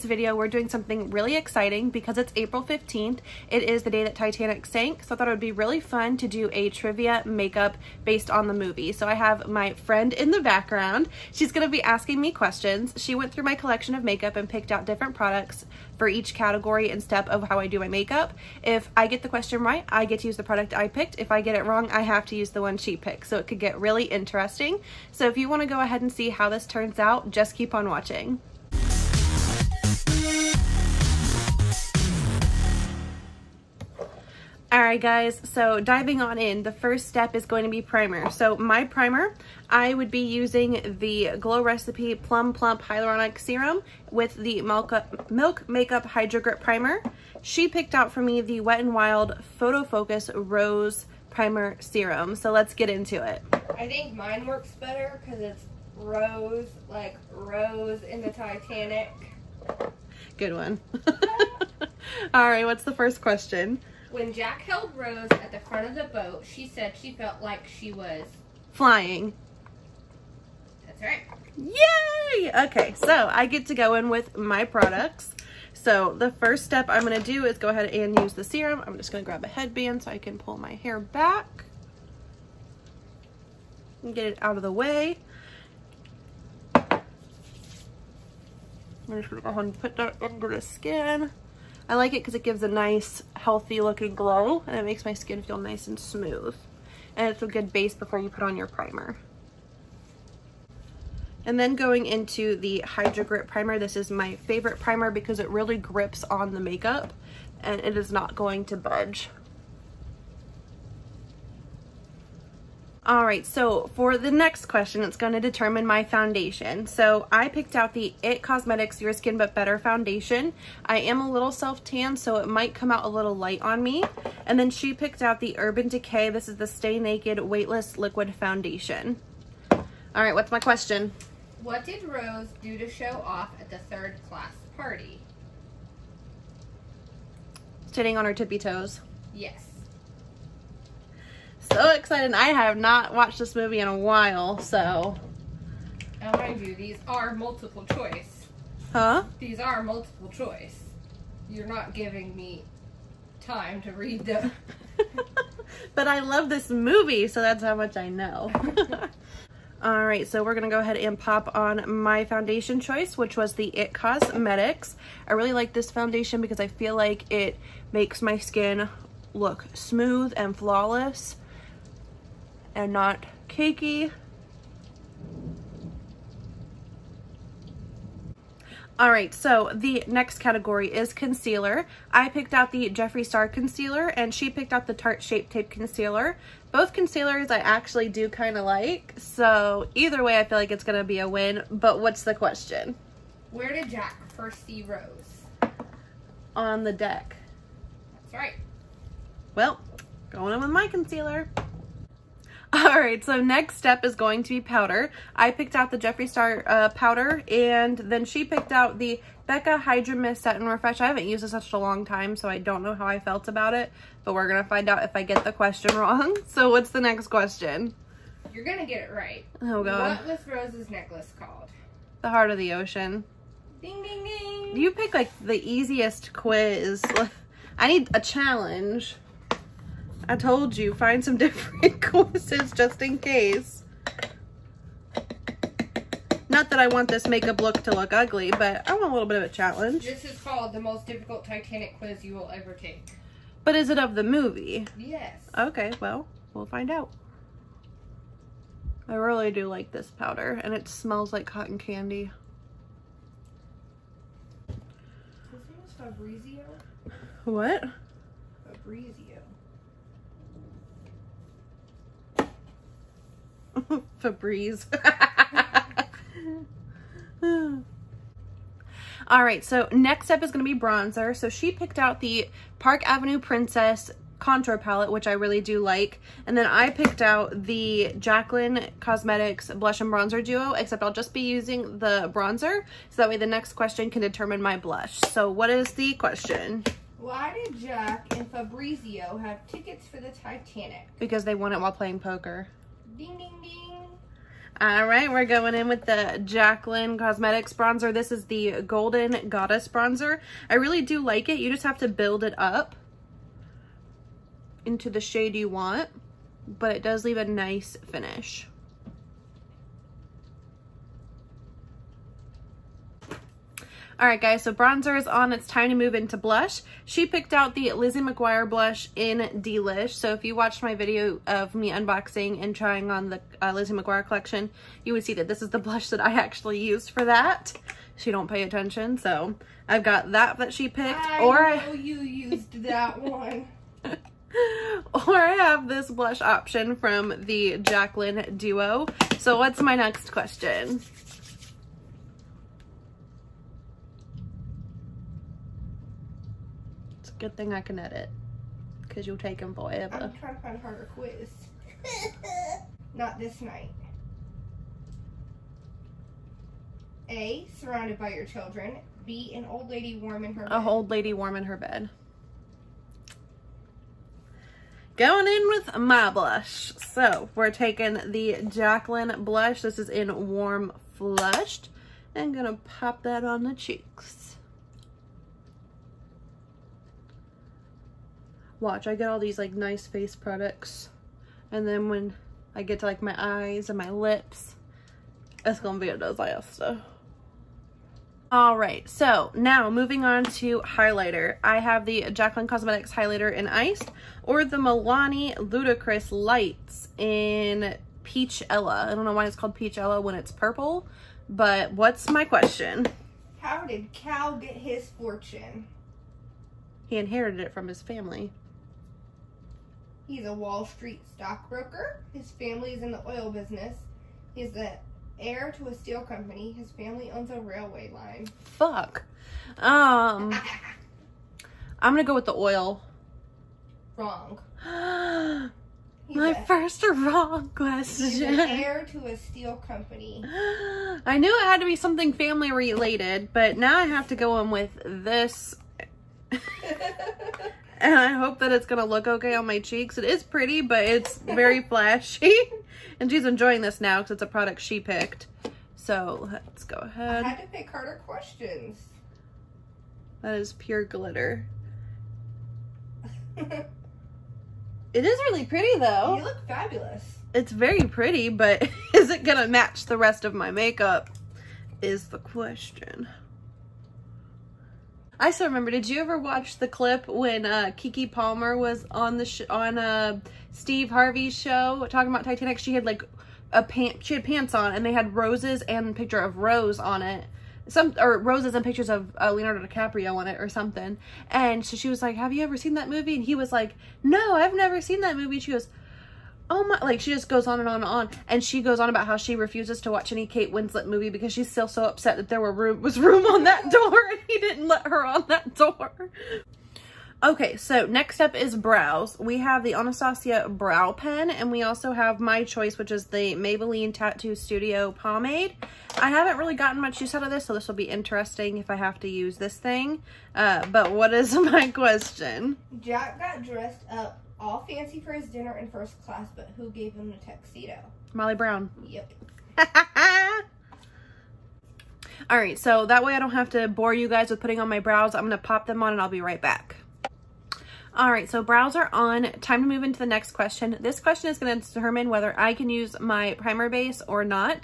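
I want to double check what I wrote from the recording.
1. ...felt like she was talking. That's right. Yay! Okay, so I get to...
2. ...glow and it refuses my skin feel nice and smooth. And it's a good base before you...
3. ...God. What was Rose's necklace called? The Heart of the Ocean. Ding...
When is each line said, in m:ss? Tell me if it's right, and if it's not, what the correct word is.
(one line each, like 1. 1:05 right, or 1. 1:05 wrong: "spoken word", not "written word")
1. 1:07 wrong: "flying", not "talking"
2. 1:34 wrong: "makes", not "refuses"
3. 3:39 right.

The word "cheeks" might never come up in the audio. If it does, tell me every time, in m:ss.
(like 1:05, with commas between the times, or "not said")
6:13, 7:19.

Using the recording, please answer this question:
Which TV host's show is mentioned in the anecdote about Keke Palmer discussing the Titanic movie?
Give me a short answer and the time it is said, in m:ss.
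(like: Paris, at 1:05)
Steve Harvey, at 7:50.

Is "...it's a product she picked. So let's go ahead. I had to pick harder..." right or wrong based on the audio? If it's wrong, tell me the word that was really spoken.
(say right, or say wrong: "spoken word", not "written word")
right.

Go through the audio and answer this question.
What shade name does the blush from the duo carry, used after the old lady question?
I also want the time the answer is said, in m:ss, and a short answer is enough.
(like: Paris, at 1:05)
Warm Flushed, at 6:10.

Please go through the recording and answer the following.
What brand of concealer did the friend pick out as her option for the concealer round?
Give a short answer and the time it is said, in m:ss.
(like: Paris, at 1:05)
Tarte, at 3:04.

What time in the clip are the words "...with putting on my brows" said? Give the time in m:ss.
8:44.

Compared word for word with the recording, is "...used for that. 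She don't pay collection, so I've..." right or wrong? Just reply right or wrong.
wrong.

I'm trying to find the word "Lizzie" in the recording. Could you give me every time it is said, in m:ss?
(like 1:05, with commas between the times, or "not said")
5:17, 5:23.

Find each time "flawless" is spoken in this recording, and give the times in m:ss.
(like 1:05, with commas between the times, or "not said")
2:50.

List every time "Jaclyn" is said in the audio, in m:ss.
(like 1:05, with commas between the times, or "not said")
4:38, 4:56, 5:37, 6:08, 6:32.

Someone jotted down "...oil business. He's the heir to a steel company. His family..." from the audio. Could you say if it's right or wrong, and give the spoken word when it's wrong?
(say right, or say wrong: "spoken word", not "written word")
right.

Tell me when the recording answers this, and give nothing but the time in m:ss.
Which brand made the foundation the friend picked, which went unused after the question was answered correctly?
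2:05.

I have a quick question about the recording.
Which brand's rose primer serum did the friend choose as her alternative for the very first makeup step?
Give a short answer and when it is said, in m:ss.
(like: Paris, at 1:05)
Wet n Wild, at 0:48.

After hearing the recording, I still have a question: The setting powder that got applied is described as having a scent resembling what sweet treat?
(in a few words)
cotton candy.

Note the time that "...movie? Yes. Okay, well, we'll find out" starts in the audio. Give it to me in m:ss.
4:04.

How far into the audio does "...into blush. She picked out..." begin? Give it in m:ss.
5:16.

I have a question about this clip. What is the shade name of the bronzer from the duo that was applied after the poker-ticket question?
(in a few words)
Golden Goddess.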